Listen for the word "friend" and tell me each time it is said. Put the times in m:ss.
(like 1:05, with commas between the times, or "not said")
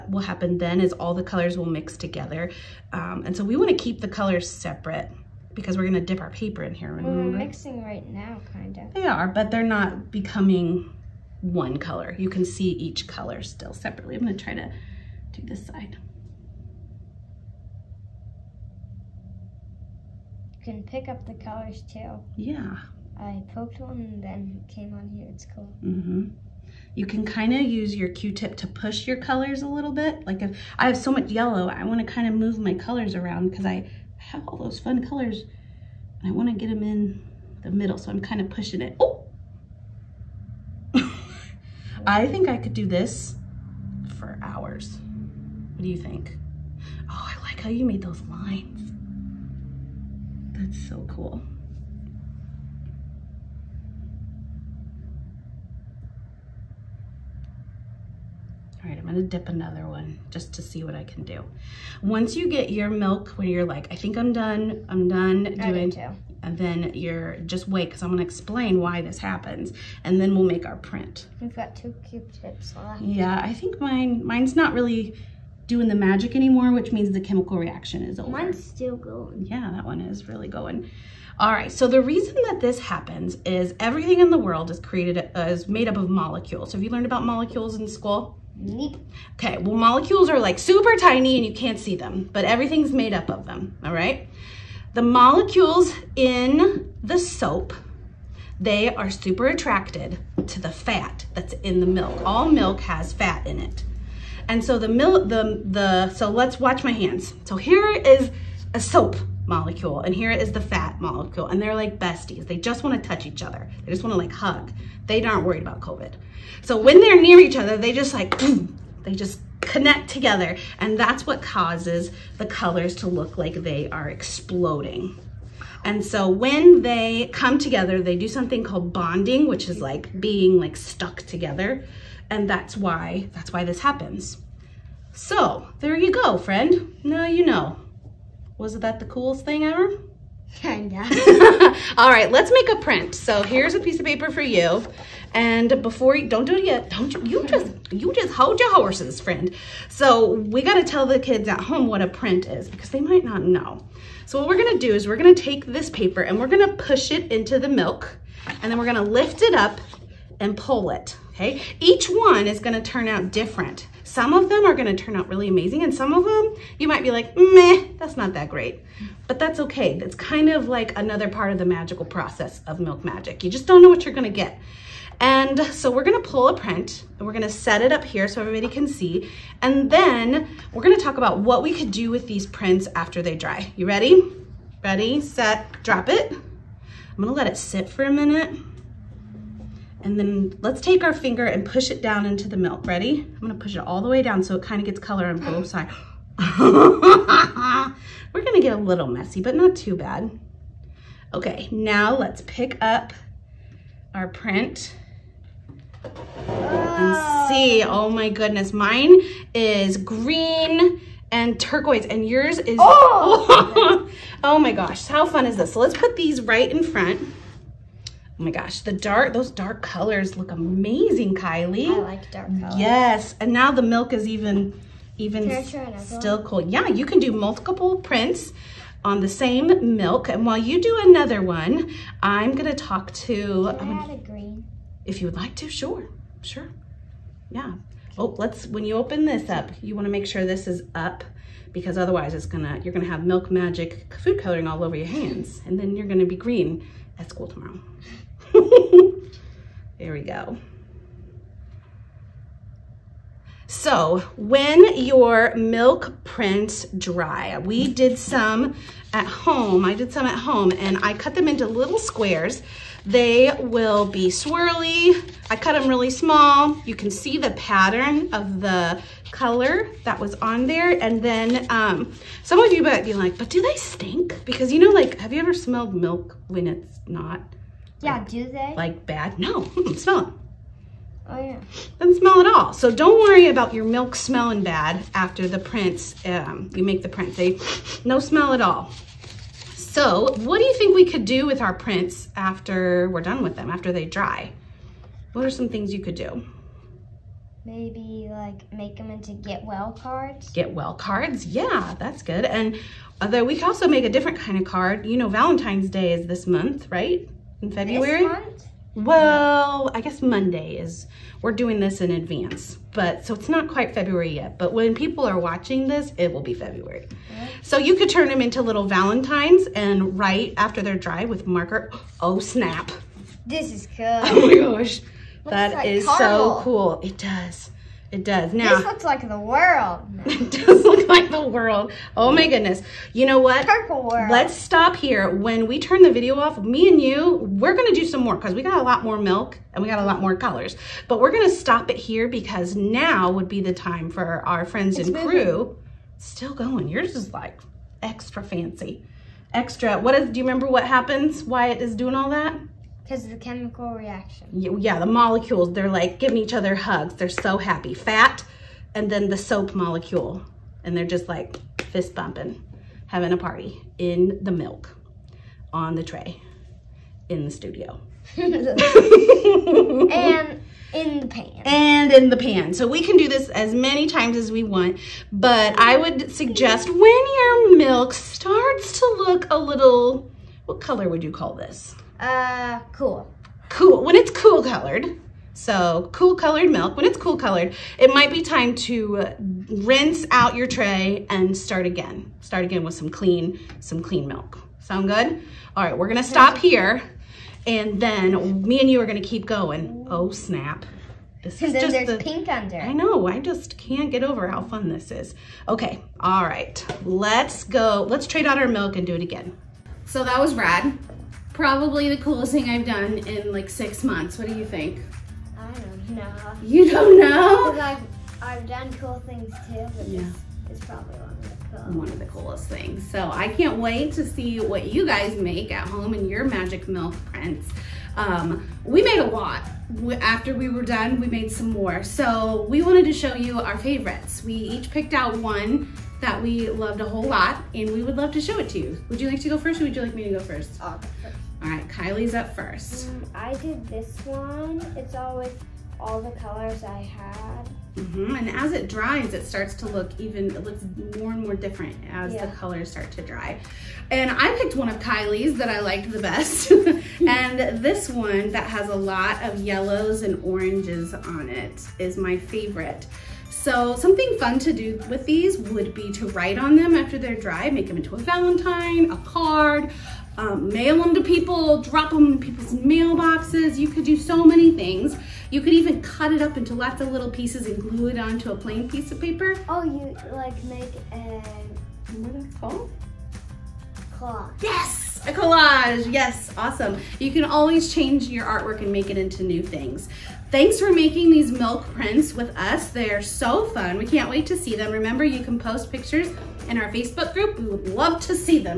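2:16, 2:29, 5:44.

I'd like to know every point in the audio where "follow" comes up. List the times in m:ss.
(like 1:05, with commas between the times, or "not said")
not said.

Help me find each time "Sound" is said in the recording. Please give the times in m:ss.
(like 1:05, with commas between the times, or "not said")
6:34.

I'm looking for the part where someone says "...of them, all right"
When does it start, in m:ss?
1:33.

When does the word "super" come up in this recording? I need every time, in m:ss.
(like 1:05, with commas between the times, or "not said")
1:30, 1:39.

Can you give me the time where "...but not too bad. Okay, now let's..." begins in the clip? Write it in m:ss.
3:19.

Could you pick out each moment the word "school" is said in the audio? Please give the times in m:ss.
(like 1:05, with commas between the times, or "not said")
1:27, 4:07.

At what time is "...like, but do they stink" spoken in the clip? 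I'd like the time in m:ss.
4:33.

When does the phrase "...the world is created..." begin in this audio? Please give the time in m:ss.
1:24.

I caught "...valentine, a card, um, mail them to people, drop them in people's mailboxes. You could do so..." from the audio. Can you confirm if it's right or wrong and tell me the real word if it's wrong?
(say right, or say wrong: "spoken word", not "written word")
right.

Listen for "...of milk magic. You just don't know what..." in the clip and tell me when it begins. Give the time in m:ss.
2:52.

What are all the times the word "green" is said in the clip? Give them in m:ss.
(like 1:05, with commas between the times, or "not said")
3:29, 4:06.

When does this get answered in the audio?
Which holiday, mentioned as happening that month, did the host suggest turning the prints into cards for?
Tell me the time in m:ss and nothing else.
5:05.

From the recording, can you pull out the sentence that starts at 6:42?
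I know, I just can't get over how fun this is.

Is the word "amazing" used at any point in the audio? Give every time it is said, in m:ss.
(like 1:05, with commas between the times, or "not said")
2:45, 3:40.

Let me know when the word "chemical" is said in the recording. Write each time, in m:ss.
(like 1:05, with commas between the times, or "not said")
1:17, 5:53.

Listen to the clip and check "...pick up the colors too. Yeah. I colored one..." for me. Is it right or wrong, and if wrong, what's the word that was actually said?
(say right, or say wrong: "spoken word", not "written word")
wrong: "poked", not "colored".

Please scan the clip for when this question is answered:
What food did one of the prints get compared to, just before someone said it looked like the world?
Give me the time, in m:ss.
5:26.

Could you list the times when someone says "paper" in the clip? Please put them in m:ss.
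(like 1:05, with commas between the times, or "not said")
0:06, 2:24, 2:35, 7:59.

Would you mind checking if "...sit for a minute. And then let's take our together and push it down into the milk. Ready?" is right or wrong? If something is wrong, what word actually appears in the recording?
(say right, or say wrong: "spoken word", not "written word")
wrong: "finger", not "together".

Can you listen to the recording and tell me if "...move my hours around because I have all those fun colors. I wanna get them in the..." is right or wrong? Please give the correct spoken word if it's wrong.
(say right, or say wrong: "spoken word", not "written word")
wrong: "colors", not "hours".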